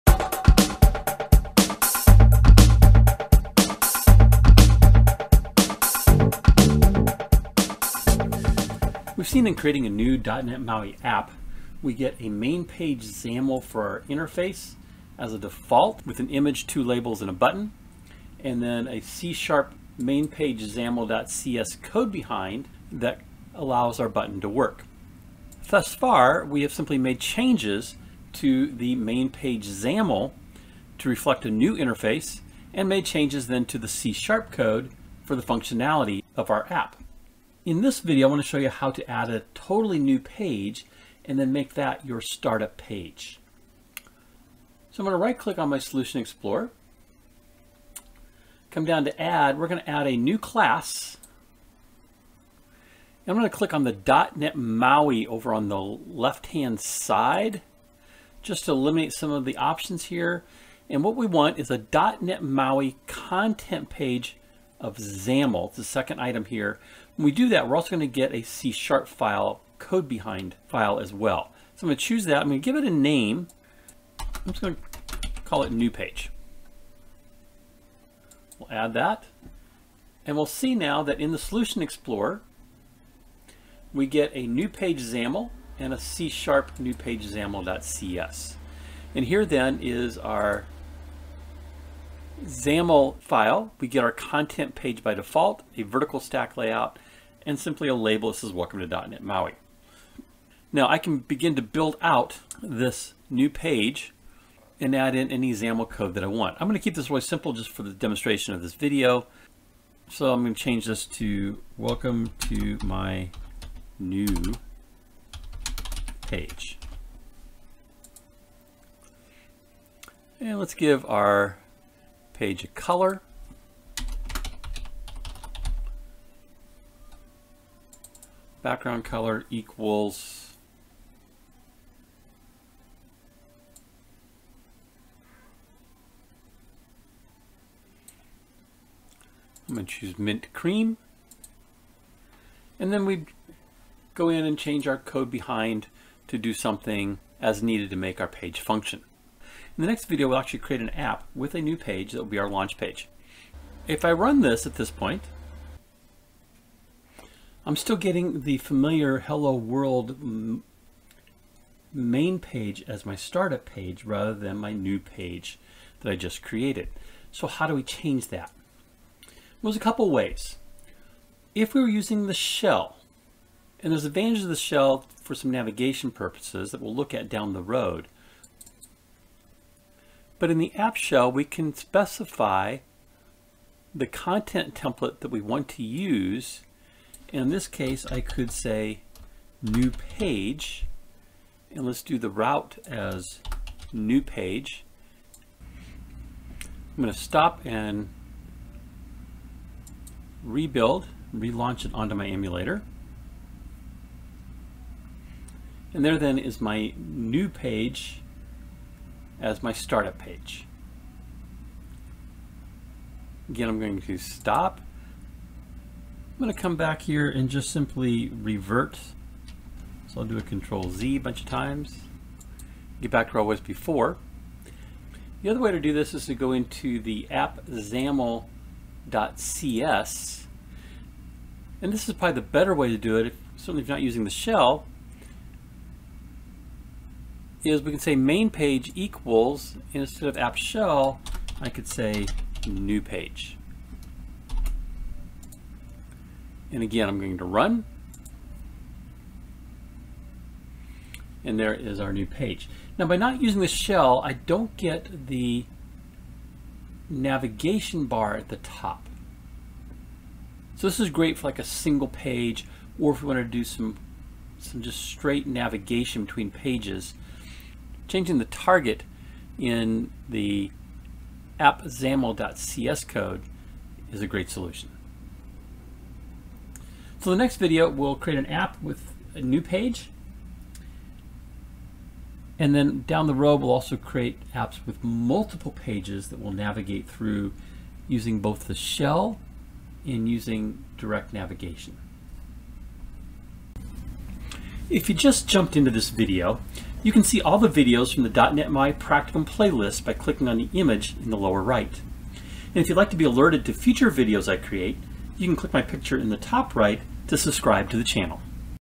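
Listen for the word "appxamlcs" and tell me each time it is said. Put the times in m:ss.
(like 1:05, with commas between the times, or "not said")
3:47, 4:31.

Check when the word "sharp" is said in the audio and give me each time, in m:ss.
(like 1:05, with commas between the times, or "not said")
0:18, 0:33, 1:08, 1:26.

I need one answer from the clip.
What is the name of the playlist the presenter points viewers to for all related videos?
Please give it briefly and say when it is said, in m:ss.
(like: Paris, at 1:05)
.NET MAUI Practicum, at 4:58.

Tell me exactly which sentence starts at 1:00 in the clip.
And what we want is a .NET MAUI content page of XAML.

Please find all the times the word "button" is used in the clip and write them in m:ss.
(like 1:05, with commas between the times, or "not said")
0:17, 0:24.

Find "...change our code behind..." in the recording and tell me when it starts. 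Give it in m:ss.
2:24.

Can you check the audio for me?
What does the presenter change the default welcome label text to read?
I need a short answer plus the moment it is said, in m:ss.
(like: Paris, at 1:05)
welcome to my new page, at 1:51.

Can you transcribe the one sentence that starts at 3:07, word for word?
In this case, I could say new page.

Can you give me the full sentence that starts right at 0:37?
In this video, I want to show you how to add a totally new page and then make that your startup page.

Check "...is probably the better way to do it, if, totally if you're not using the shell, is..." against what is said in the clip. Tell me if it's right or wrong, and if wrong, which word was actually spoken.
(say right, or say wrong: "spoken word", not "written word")
wrong: "certainly", not "totally".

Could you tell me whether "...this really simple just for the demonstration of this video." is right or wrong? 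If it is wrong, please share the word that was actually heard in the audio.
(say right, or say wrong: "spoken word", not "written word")
right.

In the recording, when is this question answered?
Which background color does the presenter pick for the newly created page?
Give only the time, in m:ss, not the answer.
2:20.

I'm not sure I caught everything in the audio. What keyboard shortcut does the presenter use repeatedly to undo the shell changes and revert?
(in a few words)
Control Z.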